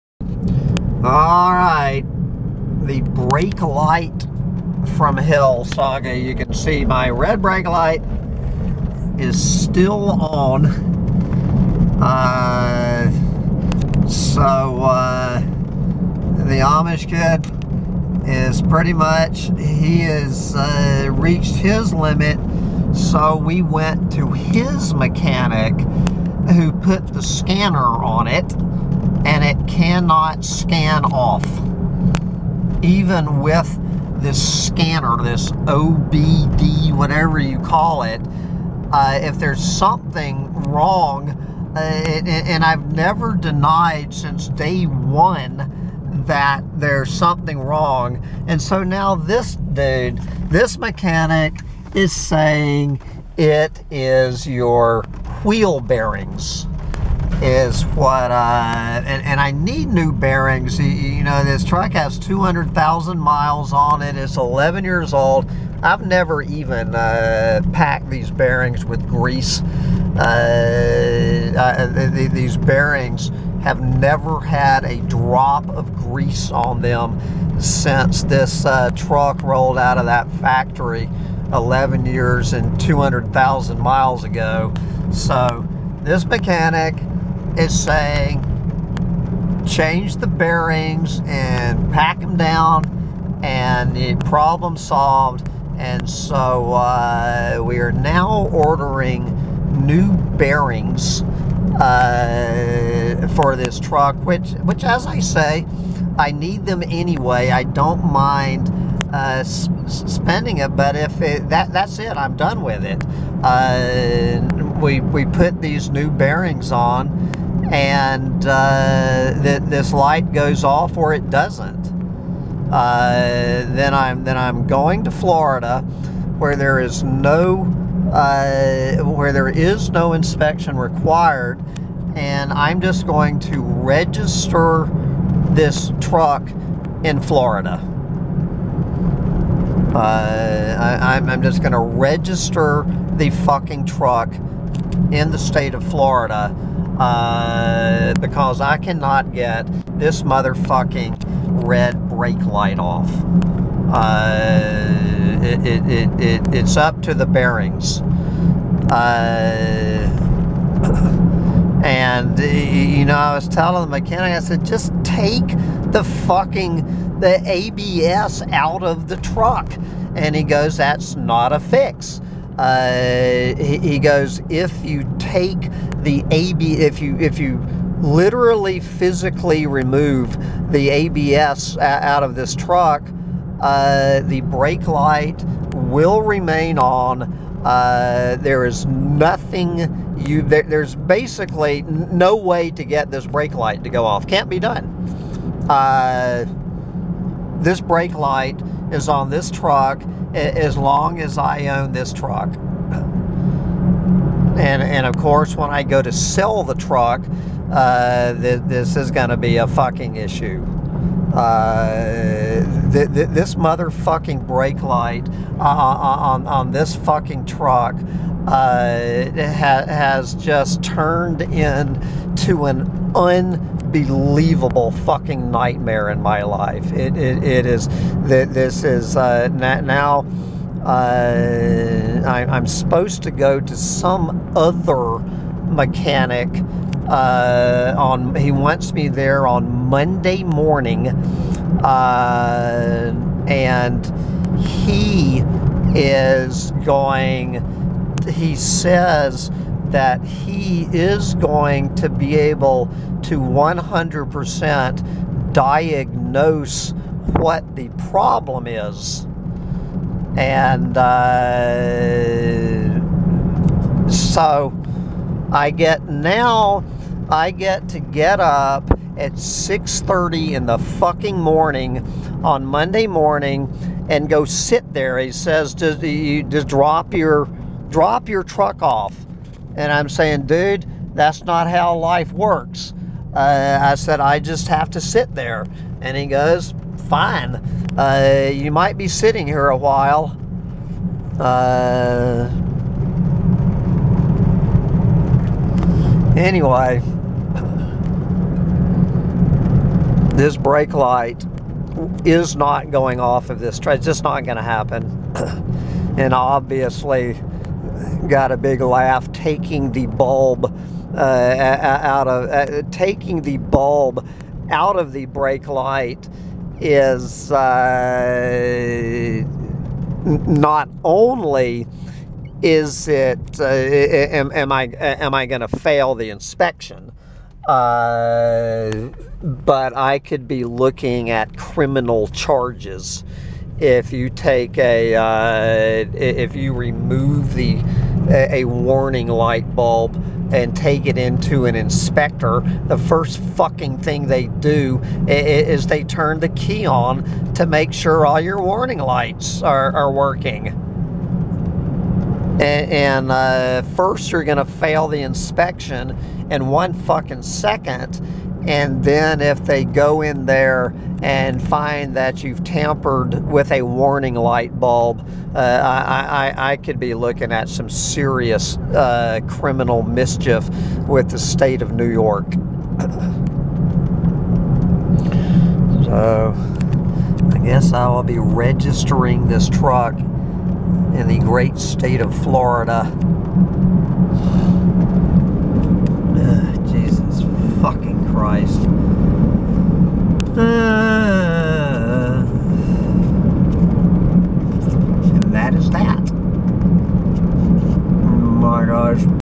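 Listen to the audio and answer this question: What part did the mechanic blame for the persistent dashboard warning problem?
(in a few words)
Wheel bearings.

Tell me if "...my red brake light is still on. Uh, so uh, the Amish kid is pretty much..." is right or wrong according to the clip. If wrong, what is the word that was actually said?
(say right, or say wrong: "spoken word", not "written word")
right.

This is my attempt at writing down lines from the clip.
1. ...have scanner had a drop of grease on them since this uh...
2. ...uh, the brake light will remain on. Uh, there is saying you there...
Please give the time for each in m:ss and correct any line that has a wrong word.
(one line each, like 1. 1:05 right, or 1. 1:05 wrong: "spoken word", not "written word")
1. 1:13 wrong: "never", not "scanner"
2. 3:03 wrong: "nothing", not "saying".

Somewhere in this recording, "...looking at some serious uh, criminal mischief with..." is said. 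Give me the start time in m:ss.
6:07.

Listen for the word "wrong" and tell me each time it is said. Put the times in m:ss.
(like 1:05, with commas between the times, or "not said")
0:40, 0:47.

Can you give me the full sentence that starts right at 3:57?
Uh, on he wants me there on Monday morning, uh, and he is going.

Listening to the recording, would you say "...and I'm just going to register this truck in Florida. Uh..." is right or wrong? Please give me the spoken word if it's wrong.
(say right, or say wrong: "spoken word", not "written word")
right.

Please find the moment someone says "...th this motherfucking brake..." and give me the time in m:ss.
3:33.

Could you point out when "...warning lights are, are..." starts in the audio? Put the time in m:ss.
5:48.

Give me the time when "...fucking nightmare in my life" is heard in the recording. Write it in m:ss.
3:44.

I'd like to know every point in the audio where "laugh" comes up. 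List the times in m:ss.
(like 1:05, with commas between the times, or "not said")
5:08.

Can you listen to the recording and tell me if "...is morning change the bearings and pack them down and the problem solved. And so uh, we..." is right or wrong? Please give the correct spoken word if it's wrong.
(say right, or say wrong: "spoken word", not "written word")
wrong: "saying", not "morning".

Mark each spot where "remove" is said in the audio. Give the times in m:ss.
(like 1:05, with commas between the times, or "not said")
2:59, 5:36.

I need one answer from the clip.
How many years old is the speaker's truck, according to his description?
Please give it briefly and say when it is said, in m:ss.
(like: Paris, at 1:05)
11, at 1:04.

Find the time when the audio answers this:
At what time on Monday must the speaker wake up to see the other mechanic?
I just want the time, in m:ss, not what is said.
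4:29.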